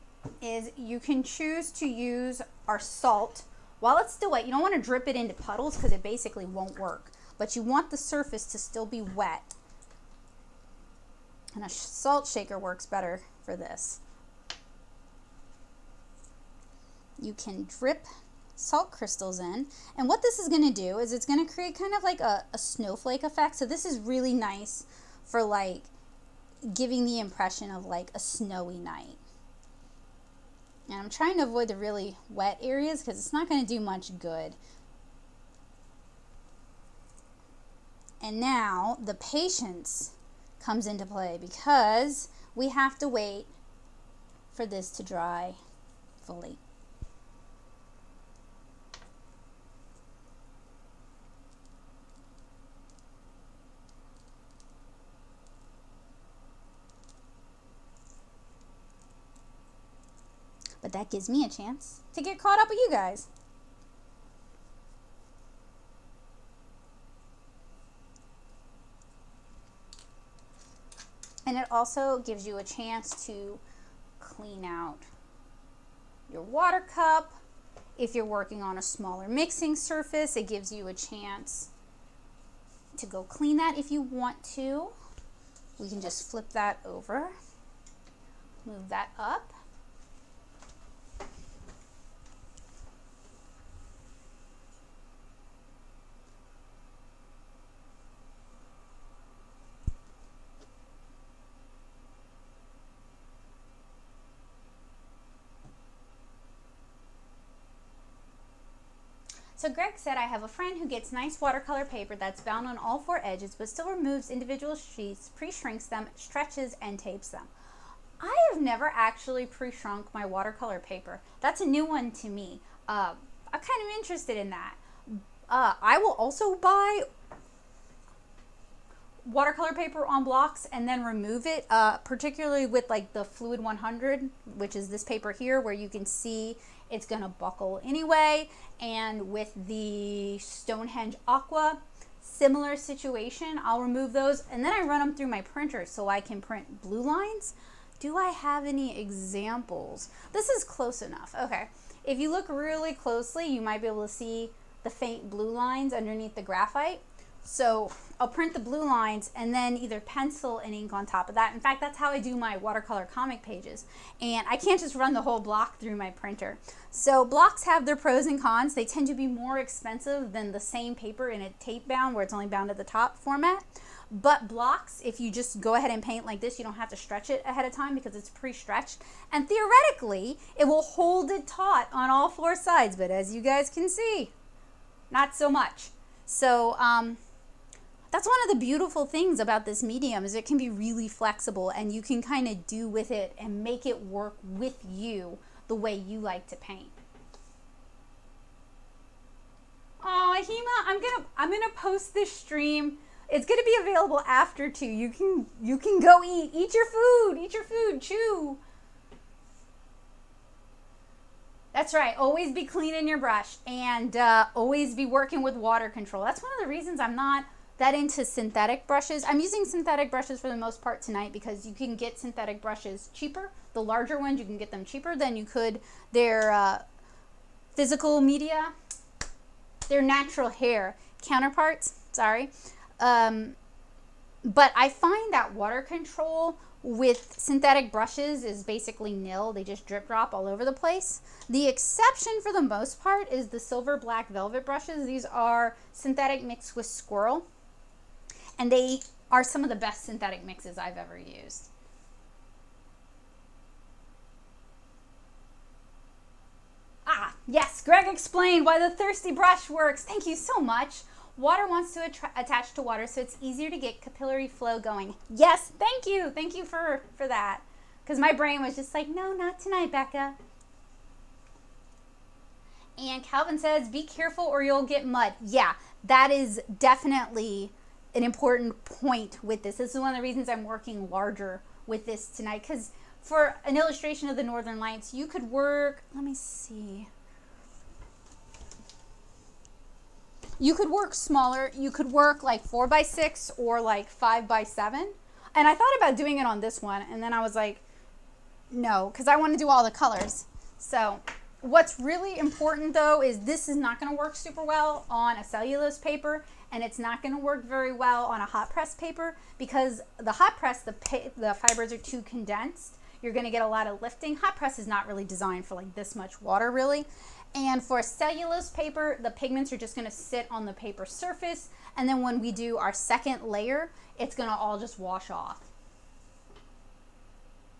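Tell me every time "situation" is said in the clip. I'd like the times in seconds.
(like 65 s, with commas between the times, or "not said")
142 s.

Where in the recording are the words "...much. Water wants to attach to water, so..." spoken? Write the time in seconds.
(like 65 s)
260 s.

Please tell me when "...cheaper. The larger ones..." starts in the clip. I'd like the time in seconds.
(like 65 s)
223 s.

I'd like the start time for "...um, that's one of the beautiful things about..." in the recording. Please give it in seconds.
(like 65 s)
186 s.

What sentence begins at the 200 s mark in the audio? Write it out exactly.
Oh, Hema, I'm gonna I'm gonna post this stream.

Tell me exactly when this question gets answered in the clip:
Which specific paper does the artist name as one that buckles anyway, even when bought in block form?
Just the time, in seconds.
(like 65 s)
133 s.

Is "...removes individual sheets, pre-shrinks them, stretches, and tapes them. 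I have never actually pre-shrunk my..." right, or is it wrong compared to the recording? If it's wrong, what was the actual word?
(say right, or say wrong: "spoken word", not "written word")
right.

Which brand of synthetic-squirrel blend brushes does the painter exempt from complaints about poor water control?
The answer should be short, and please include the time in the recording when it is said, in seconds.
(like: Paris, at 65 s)
Silver Black Velvet, at 243 s.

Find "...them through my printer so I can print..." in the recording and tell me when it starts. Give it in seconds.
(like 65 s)
144 s.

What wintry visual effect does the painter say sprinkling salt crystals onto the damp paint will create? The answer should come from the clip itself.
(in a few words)
snowflake effect.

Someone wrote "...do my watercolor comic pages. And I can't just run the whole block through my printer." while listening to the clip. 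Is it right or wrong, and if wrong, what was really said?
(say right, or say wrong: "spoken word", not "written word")
right.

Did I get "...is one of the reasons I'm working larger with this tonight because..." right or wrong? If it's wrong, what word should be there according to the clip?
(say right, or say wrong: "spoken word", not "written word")
right.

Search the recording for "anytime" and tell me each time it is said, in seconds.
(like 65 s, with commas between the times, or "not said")
not said.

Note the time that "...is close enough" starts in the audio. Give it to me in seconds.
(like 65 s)
150 s.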